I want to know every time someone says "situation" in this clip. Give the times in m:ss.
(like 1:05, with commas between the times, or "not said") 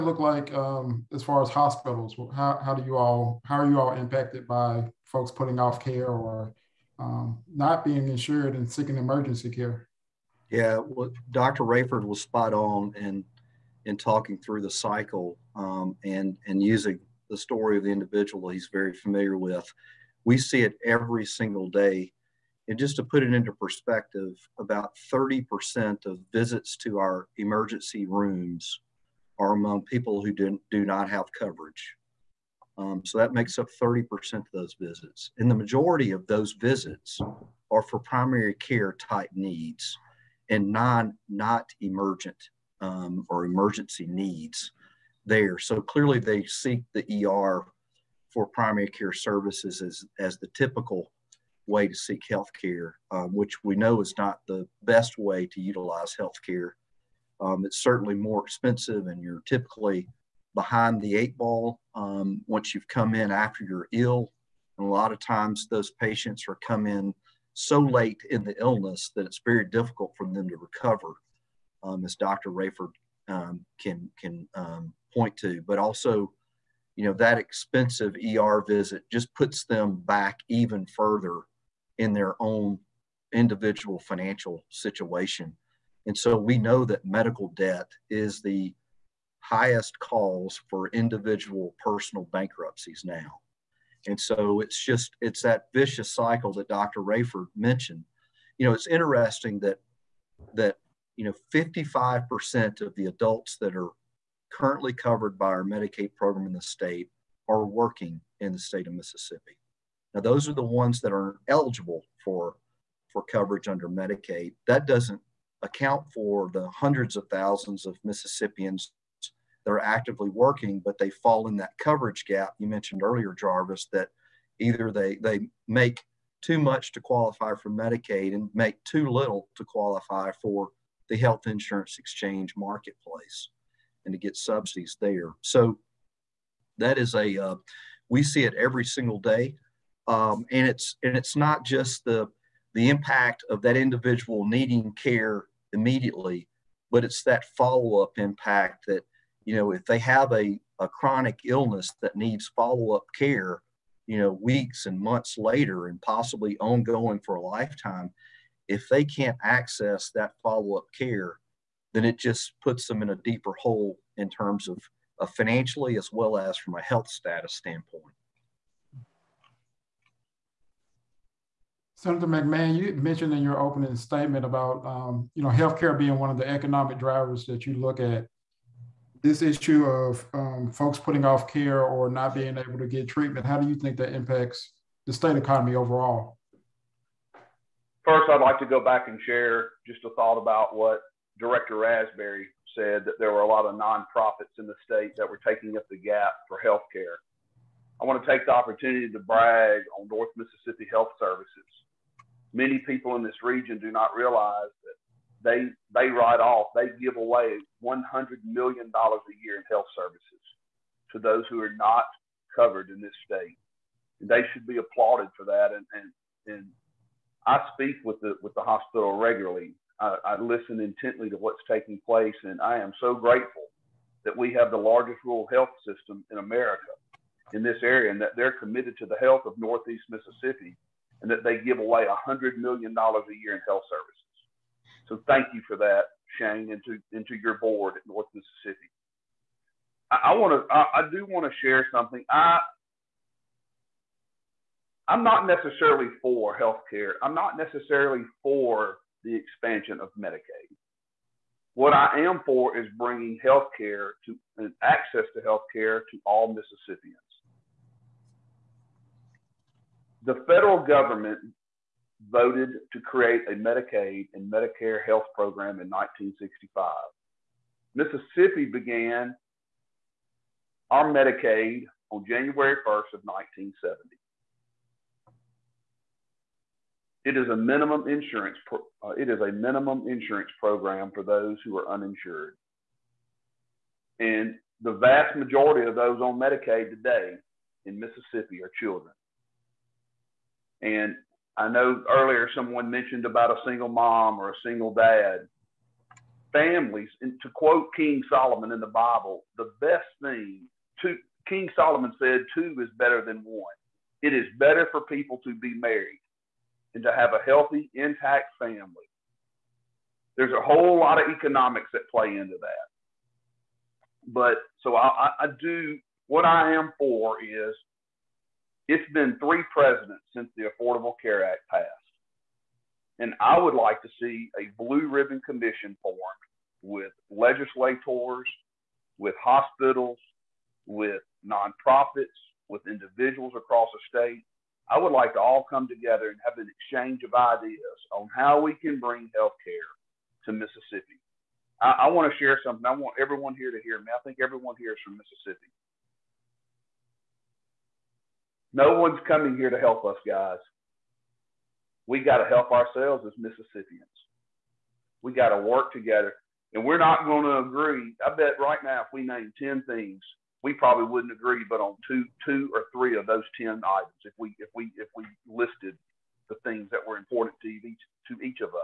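1:24.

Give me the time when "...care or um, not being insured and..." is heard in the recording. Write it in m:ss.
0:05.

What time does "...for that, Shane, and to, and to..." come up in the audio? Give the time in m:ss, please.
3:55.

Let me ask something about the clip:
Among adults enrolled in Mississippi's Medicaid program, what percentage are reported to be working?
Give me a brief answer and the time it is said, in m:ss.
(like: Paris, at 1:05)
55%, at 1:41.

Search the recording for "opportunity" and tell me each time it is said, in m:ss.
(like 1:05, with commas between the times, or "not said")
3:18.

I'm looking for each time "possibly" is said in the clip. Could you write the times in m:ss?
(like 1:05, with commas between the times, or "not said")
2:36.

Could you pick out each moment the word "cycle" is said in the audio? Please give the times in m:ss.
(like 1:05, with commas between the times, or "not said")
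0:14, 1:36.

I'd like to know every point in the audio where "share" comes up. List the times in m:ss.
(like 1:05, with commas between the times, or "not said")
3:09, 4:01, 5:42.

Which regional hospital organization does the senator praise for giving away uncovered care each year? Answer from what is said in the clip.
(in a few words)
North Mississippi Health Services.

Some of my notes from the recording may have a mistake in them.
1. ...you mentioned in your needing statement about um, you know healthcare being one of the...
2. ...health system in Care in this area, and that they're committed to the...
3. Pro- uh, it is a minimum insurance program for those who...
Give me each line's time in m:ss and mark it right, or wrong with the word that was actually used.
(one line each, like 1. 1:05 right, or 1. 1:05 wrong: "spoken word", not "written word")
1. 2:52 wrong: "opening", not "needing"
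2. 3:45 wrong: "America", not "Care"
3. 4:38 right.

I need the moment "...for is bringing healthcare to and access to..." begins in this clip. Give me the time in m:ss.
4:12.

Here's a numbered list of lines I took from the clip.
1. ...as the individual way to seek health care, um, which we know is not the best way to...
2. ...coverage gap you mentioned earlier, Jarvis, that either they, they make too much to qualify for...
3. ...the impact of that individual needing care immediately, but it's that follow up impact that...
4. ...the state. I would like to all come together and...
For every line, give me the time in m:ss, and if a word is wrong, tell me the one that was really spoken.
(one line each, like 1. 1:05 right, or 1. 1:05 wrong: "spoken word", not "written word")
1. 0:50 wrong: "typical", not "individual"
2. 2:01 right
3. 2:22 right
4. 5:33 right.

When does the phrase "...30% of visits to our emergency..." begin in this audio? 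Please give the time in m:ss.
0:25.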